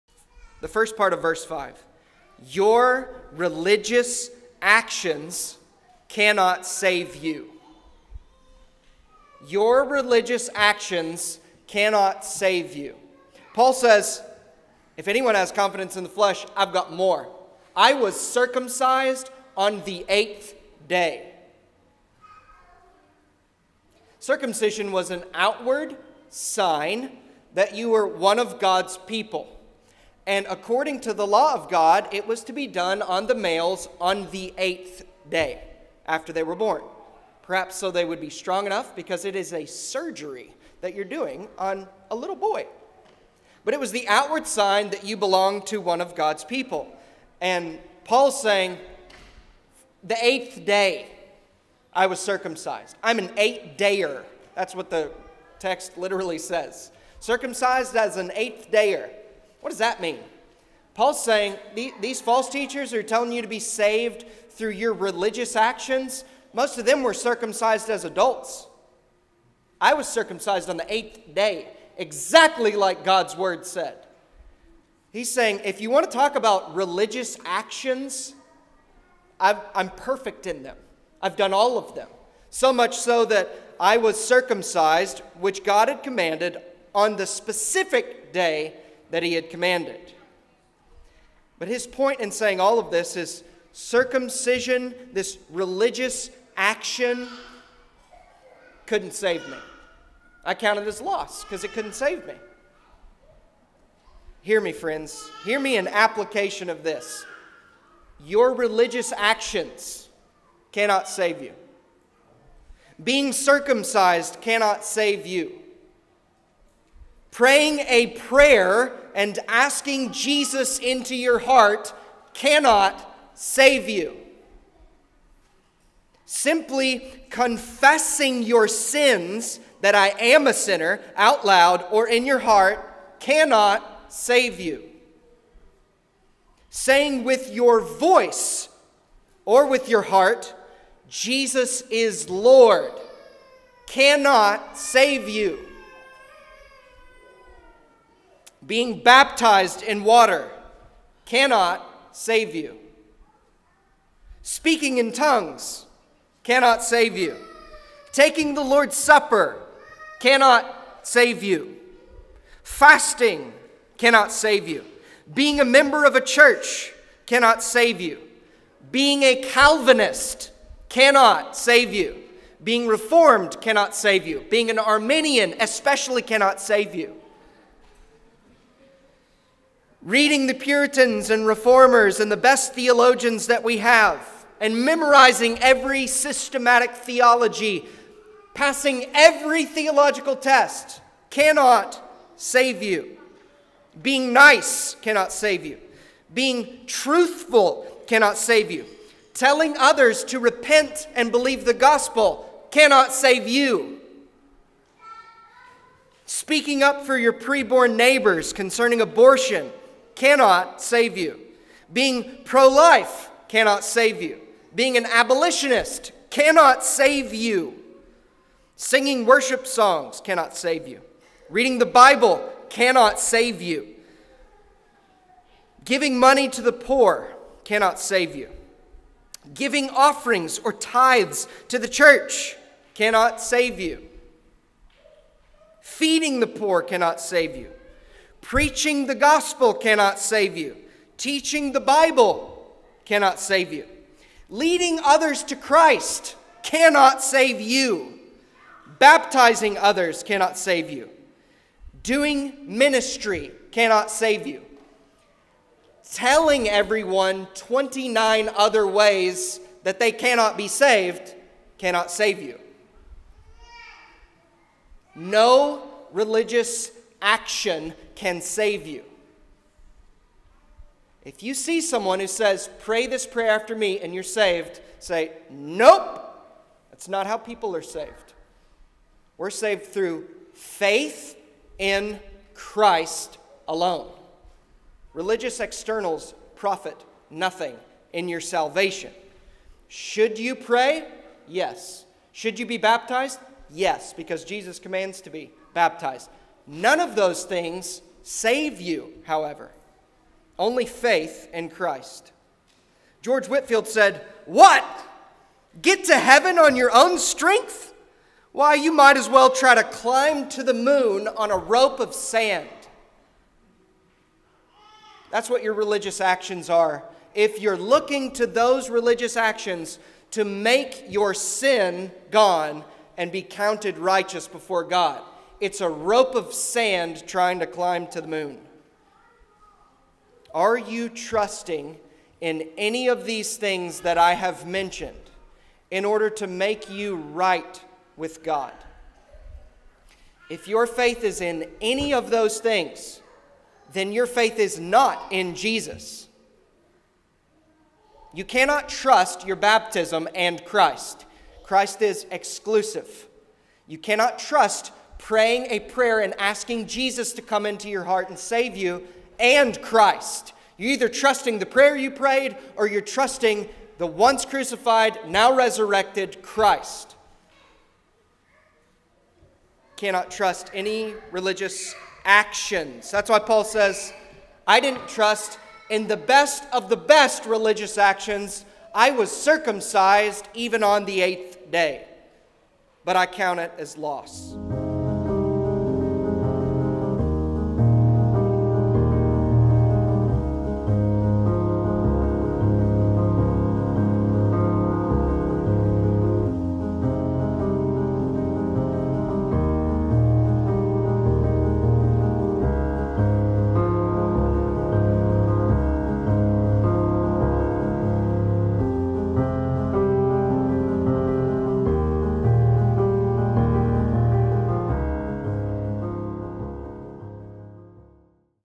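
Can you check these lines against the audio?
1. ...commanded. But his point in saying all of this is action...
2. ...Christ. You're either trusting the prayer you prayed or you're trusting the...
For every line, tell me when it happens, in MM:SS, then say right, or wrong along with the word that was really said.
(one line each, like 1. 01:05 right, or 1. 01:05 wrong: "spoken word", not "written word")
1. 01:29 wrong: "circumcision", not "action"
2. 05:59 right.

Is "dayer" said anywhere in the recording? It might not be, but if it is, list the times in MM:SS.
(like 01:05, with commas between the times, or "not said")
00:53, 00:58.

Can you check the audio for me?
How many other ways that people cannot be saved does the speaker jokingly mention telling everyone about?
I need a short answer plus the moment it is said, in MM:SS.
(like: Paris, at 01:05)
29, at 04:17.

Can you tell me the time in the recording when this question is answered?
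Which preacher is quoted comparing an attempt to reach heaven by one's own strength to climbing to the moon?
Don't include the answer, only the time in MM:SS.
05:03.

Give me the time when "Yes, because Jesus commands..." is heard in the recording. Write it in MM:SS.
04:53.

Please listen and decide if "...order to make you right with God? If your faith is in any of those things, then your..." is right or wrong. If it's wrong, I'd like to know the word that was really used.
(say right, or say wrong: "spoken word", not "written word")
right.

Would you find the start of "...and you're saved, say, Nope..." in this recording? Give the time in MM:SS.
04:33.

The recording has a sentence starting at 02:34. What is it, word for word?
Speaking in tongues cannot save you.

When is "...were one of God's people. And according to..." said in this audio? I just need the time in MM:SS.
00:27.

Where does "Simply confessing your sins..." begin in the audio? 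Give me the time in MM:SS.
02:06.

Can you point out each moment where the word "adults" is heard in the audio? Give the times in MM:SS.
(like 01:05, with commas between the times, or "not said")
01:08.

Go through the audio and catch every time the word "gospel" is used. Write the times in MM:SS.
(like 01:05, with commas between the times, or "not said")
03:21, 03:59.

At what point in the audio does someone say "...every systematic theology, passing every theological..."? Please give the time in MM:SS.
03:05.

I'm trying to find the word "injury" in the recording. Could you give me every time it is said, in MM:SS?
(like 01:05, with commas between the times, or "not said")
not said.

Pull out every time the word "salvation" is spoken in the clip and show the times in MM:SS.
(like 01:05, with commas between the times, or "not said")
04:48.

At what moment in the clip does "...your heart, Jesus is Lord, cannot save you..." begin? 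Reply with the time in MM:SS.
02:19.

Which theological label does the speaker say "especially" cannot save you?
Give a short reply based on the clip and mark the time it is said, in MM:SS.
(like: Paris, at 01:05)
Arminian, at 02:54.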